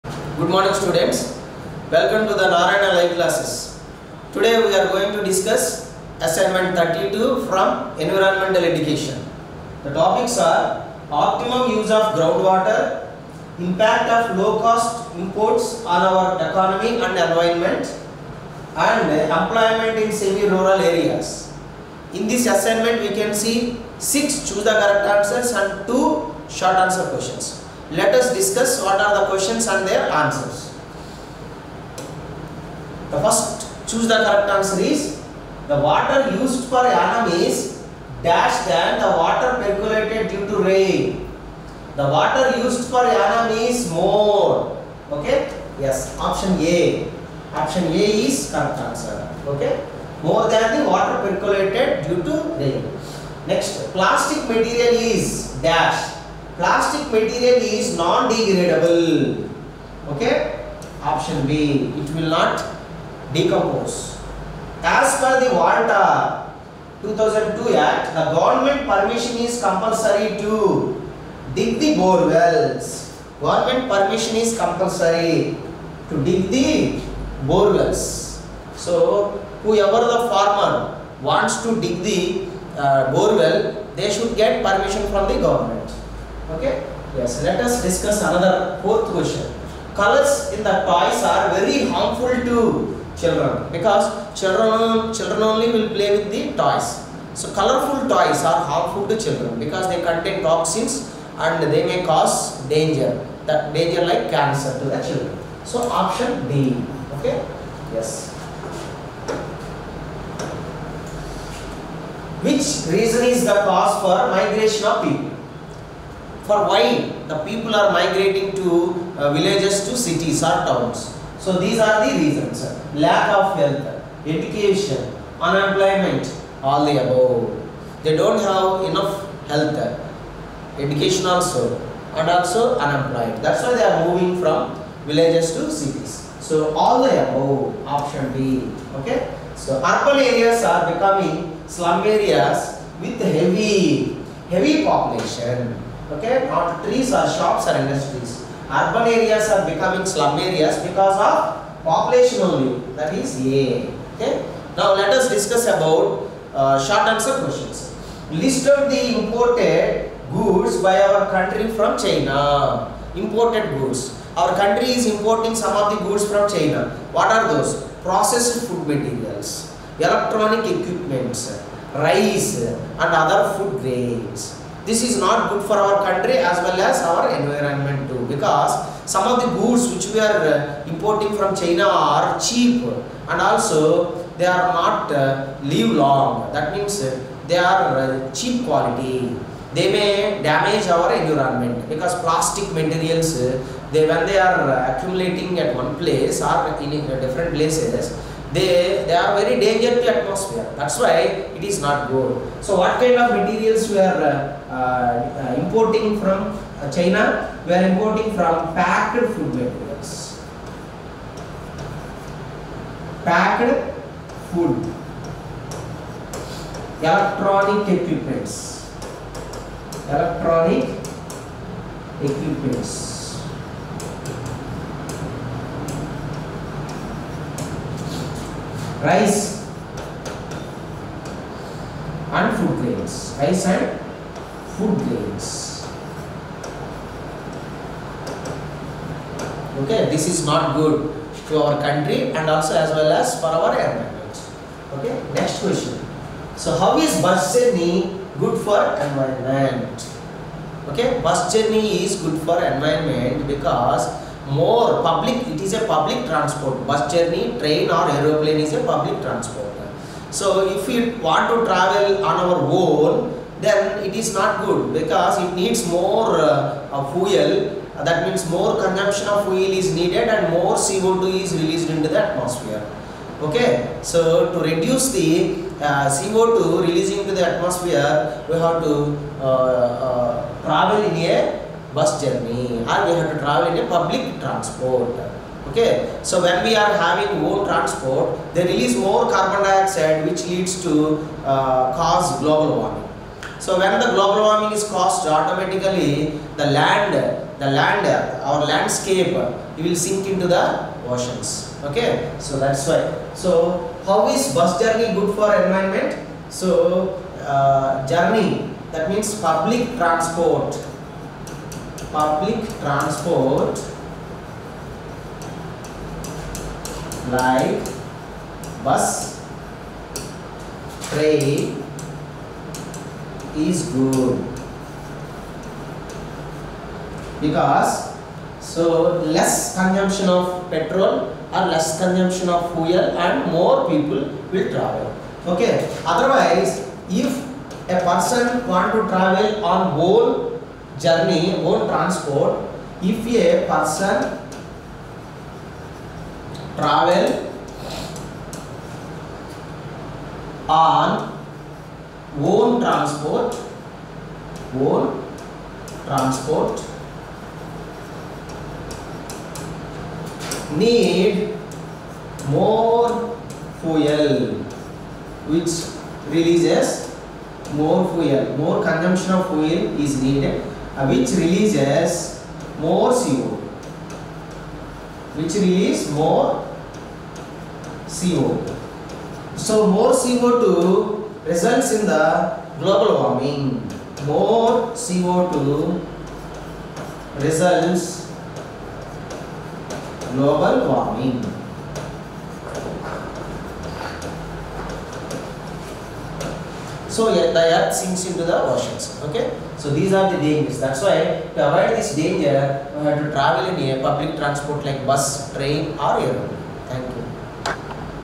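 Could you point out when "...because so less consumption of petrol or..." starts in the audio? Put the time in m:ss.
5:27.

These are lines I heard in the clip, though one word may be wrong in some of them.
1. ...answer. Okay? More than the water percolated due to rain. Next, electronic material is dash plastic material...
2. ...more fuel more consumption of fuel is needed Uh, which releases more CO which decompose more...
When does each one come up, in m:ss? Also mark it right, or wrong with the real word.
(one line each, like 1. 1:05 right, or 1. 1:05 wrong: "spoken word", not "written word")
1. 0:48 wrong: "plastic", not "electronic"
2. 6:07 wrong: "release", not "decompose".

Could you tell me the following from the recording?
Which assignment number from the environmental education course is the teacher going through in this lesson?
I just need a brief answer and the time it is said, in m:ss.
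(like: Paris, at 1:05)
32, at 0:06.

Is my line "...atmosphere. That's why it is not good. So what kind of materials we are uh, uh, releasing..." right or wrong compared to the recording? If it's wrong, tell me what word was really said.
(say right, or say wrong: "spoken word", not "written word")
wrong: "importing", not "releasing".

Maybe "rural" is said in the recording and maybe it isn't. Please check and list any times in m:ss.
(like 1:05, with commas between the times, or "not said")
0:20.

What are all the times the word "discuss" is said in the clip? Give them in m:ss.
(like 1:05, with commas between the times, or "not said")
0:05, 0:28, 1:27, 2:35.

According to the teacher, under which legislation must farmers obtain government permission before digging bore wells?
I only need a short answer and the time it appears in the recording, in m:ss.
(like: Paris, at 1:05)
WALTA 2002 Act, at 1:05.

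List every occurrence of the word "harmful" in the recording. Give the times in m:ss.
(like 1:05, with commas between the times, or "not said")
1:31, 1:38.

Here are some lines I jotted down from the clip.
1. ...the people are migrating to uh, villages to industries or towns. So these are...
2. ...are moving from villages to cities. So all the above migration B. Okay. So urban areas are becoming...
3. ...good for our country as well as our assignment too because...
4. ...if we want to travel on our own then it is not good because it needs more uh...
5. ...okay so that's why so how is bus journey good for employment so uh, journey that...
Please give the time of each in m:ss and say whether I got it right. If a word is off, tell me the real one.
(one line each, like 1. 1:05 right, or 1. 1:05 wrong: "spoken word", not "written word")
1. 1:57 wrong: "cities", not "industries"
2. 2:13 wrong: "option", not "migration"
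3. 2:55 wrong: "environment", not "assignment"
4. 4:20 right
5. 5:01 wrong: "environment", not "employment".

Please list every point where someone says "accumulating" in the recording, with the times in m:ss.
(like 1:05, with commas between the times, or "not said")
3:14.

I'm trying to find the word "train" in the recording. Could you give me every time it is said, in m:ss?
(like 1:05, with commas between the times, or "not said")
4:17, 5:21, 6:45.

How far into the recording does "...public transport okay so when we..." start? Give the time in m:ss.
4:43.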